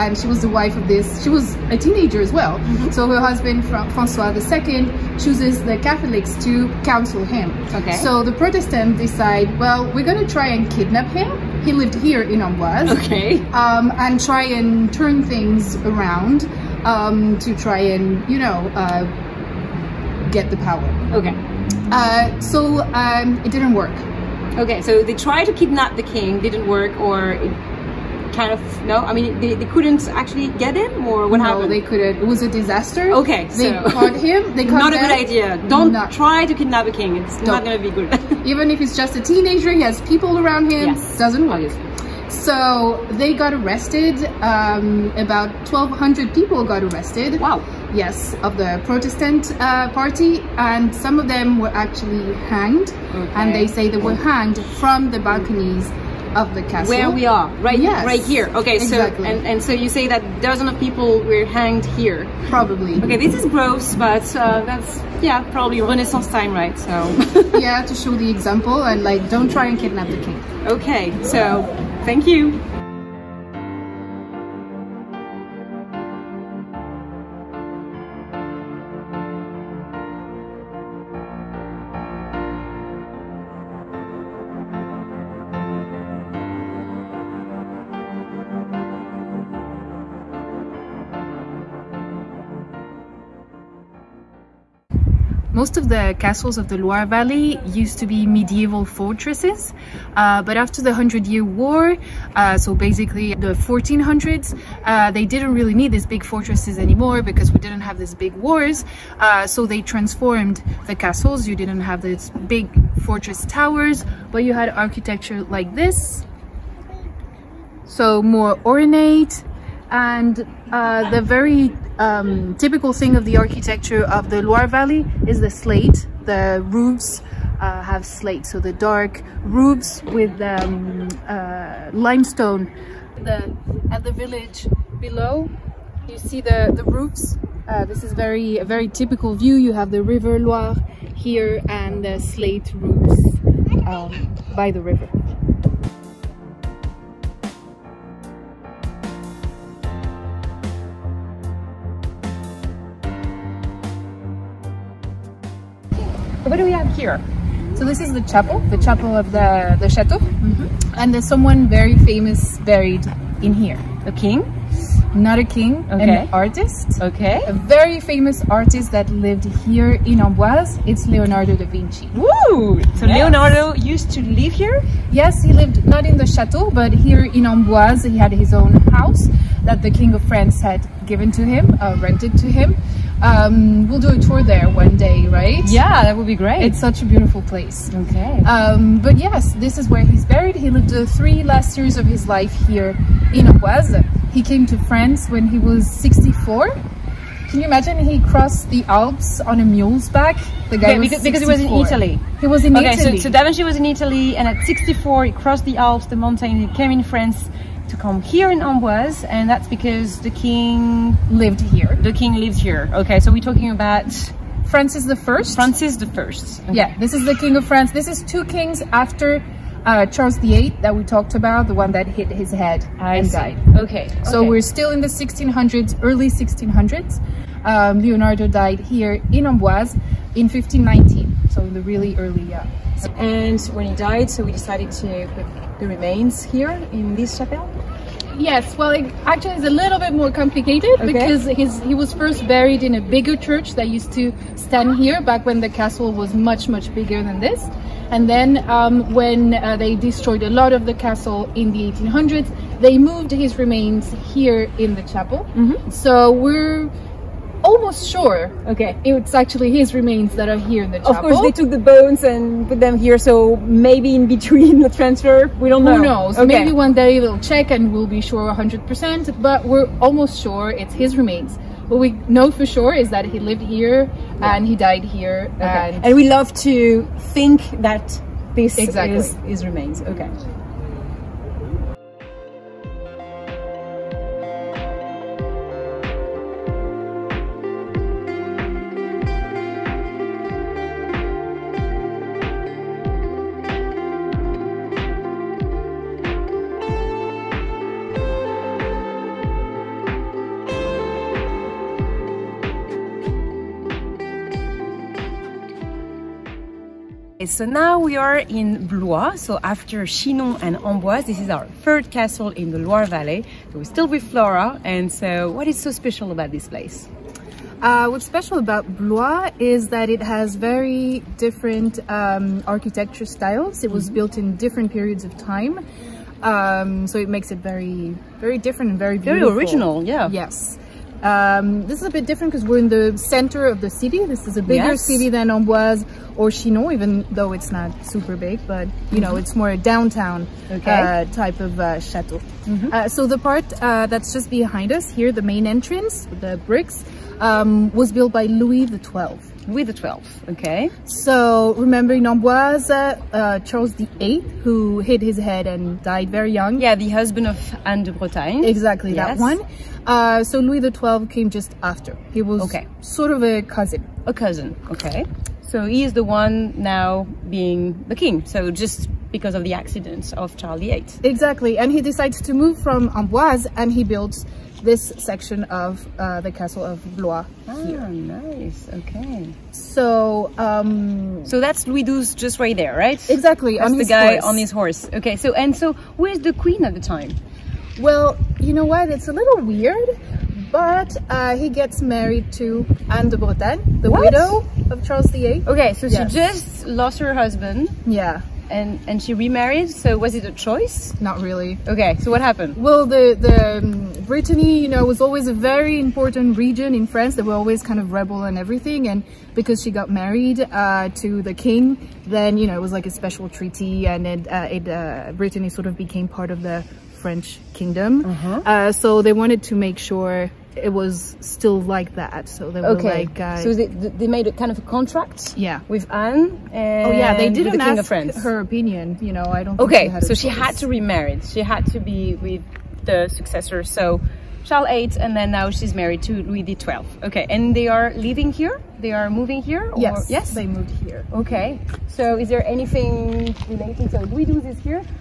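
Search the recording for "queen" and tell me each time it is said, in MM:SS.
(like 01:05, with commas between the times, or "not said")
06:26.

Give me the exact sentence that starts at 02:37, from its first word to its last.
So this is the chapel, the chapel of the, the chateau.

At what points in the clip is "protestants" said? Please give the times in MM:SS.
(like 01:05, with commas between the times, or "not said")
00:08, 00:48.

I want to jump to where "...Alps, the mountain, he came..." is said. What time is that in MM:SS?
03:25.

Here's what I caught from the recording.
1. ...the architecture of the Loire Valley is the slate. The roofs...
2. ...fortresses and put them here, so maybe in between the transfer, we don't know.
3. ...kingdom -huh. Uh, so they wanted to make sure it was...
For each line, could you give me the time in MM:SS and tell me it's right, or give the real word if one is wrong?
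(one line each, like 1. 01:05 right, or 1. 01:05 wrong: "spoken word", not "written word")
1. 02:03 right
2. 04:21 wrong: "bones", not "fortresses"
3. 06:57 right.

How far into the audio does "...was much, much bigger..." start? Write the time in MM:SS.
04:06.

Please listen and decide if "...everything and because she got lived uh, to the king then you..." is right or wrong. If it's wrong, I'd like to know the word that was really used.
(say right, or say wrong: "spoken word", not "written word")
wrong: "married", not "lived".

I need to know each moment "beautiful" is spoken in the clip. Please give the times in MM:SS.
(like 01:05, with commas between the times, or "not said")
03:07, 05:29.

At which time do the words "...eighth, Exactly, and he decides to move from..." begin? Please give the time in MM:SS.
06:10.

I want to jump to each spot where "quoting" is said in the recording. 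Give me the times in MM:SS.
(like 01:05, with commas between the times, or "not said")
not said.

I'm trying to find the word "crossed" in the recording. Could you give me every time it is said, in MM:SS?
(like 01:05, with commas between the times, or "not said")
03:18, 03:25.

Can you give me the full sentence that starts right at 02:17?
Uh, this is very a very typical view.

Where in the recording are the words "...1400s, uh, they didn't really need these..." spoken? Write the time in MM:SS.
01:43.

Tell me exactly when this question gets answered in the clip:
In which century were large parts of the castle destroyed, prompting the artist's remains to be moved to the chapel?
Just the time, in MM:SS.
04:11.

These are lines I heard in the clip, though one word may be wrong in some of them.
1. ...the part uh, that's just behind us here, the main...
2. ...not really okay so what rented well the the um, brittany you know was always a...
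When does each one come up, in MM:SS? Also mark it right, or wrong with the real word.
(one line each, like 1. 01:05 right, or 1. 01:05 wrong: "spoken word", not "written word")
1. 05:43 right
2. 06:41 wrong: "happened", not "rented".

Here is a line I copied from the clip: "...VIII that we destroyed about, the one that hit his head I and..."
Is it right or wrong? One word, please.
wrong.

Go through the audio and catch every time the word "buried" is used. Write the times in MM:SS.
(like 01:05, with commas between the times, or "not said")
02:42, 03:10, 04:02.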